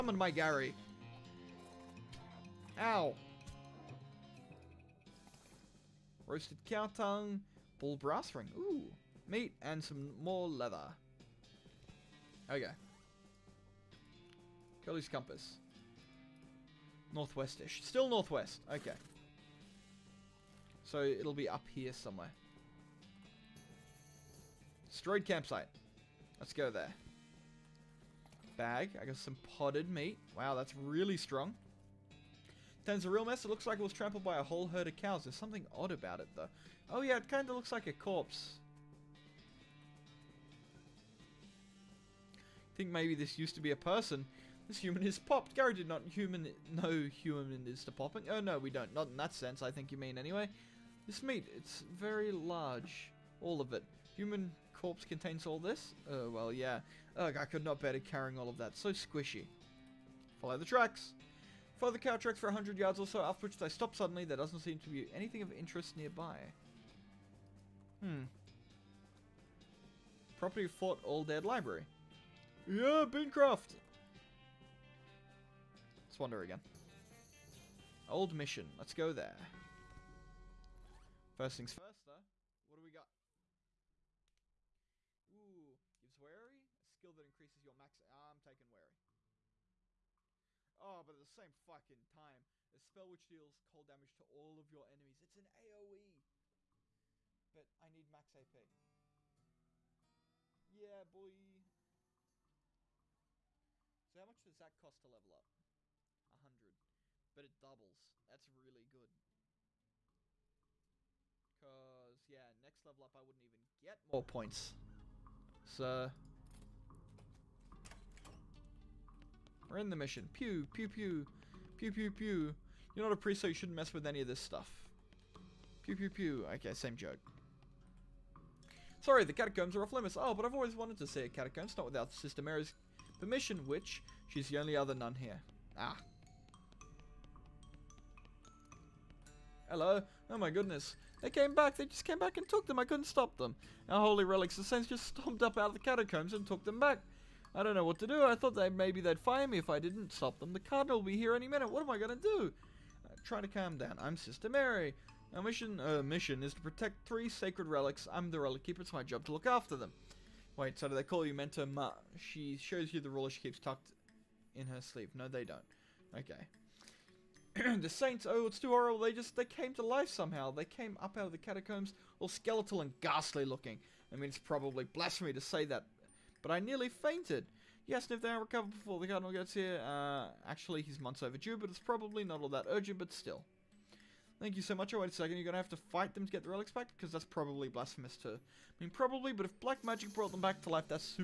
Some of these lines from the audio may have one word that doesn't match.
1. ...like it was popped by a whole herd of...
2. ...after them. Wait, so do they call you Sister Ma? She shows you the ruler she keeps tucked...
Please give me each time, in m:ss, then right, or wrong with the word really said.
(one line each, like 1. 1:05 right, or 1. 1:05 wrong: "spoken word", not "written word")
1. 0:33 wrong: "trampled", not "popped"
2. 2:39 wrong: "Mentor", not "Sister".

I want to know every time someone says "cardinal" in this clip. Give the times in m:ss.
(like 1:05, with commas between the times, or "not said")
2:30, 2:59.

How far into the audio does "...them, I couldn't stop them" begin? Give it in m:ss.
2:22.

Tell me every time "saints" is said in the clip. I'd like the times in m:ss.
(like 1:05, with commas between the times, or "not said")
2:24, 2:47.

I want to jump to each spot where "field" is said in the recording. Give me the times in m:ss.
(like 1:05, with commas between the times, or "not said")
not said.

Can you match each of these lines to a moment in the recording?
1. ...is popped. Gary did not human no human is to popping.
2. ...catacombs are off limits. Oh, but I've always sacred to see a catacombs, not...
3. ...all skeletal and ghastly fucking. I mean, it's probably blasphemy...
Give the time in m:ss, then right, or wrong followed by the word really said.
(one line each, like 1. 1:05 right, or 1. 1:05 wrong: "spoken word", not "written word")
1. 0:45 right
2. 2:09 wrong: "wanted", not "sacred"
3. 2:52 wrong: "looking", not "fucking".